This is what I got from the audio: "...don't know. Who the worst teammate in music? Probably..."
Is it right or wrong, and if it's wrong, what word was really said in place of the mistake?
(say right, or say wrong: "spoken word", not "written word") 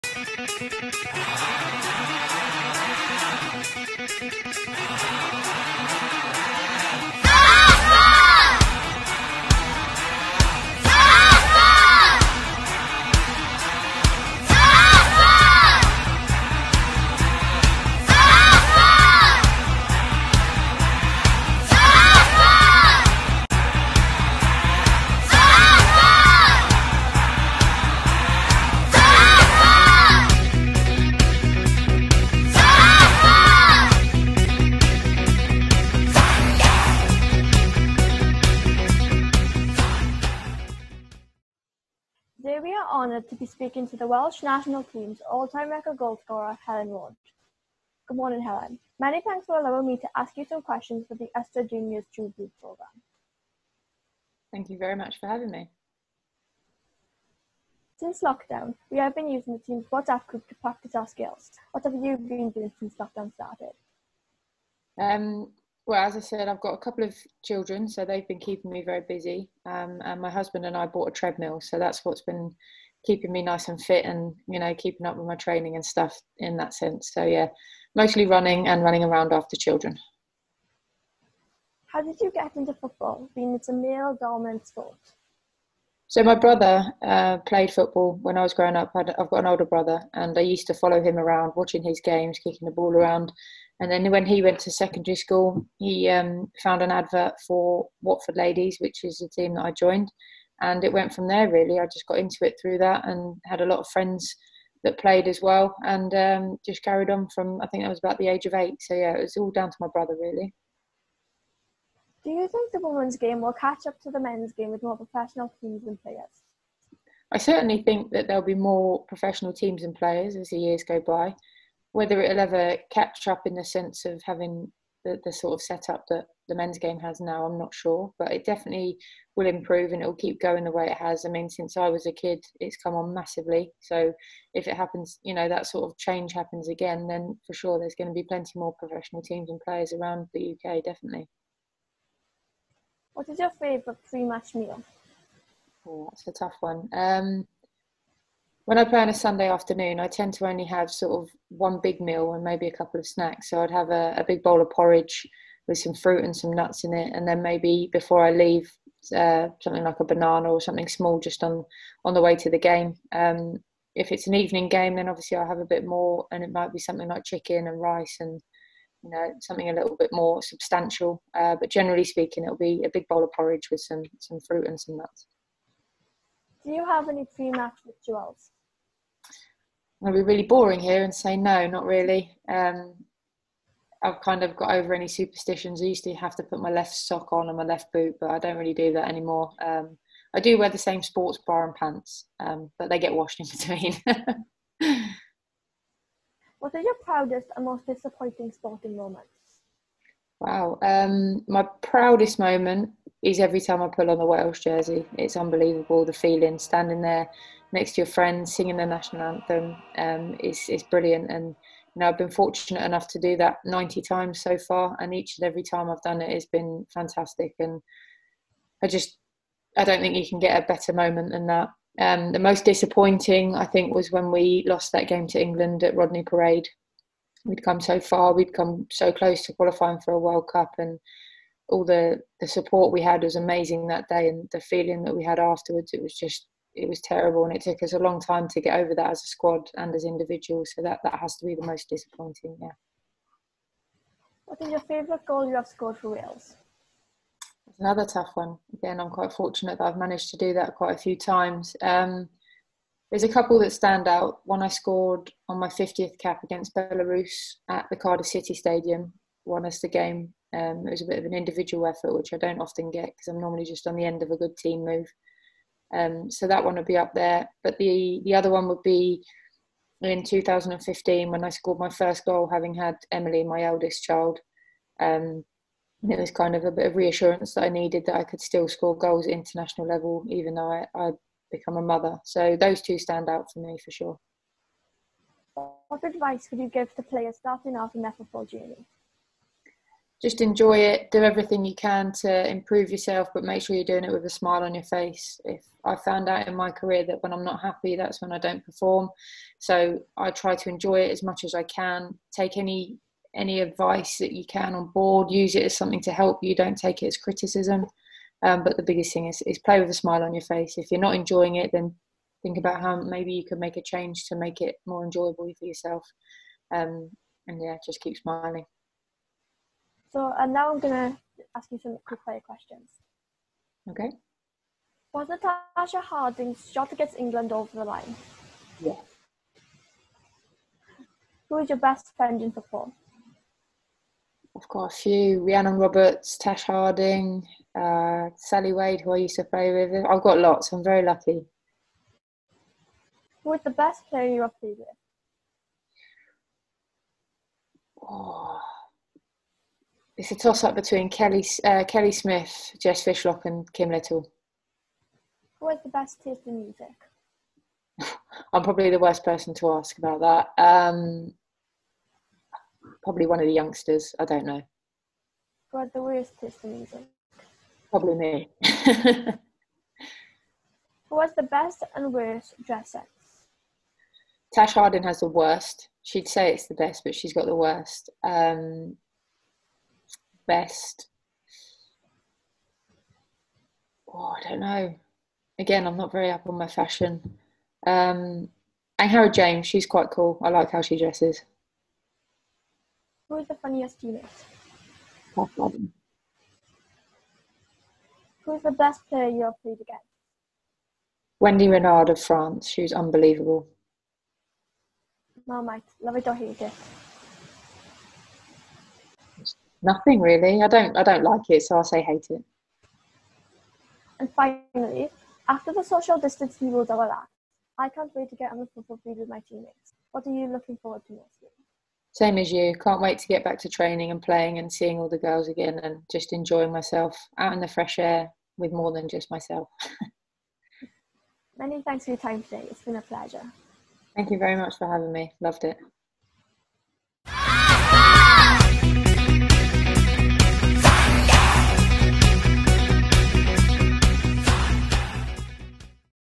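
wrong: "taste", not "teammate".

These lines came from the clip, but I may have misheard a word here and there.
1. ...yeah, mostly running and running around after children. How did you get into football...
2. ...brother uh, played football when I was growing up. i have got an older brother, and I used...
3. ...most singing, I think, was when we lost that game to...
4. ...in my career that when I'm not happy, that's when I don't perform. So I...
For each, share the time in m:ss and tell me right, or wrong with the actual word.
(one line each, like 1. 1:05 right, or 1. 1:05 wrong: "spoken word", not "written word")
1. 1:17 right
2. 1:26 right
3. 3:42 wrong: "disappointing", not "singing"
4. 4:56 right.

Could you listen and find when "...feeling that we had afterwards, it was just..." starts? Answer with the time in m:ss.
3:54.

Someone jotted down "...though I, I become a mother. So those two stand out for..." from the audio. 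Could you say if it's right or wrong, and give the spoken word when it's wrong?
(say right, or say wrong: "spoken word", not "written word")
right.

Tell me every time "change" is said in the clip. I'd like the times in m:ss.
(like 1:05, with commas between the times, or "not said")
2:15, 5:13.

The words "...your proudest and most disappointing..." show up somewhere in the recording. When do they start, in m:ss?
3:16.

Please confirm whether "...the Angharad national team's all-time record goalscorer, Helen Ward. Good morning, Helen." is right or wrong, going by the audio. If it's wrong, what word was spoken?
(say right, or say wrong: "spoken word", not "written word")
wrong: "Welsh", not "Angharad".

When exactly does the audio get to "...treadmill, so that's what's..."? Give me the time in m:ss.
1:11.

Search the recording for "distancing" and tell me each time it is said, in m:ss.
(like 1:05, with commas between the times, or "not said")
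6:56.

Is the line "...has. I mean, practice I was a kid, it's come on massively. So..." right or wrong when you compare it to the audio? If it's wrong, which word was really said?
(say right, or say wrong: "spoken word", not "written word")
wrong: "since", not "practice".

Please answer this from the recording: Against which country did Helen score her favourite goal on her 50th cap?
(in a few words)
Belarus.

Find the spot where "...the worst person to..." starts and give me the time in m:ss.
5:58.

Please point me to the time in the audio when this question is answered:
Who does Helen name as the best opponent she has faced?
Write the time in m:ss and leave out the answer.
6:41.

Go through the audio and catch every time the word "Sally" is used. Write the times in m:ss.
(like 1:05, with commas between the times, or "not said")
5:38.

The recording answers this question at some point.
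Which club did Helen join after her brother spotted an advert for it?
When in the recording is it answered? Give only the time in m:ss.
1:38.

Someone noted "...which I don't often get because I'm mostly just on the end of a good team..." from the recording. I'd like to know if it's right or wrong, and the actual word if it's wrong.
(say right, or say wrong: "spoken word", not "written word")
wrong: "normally", not "mostly".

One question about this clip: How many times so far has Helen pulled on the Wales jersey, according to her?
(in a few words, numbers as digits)
90.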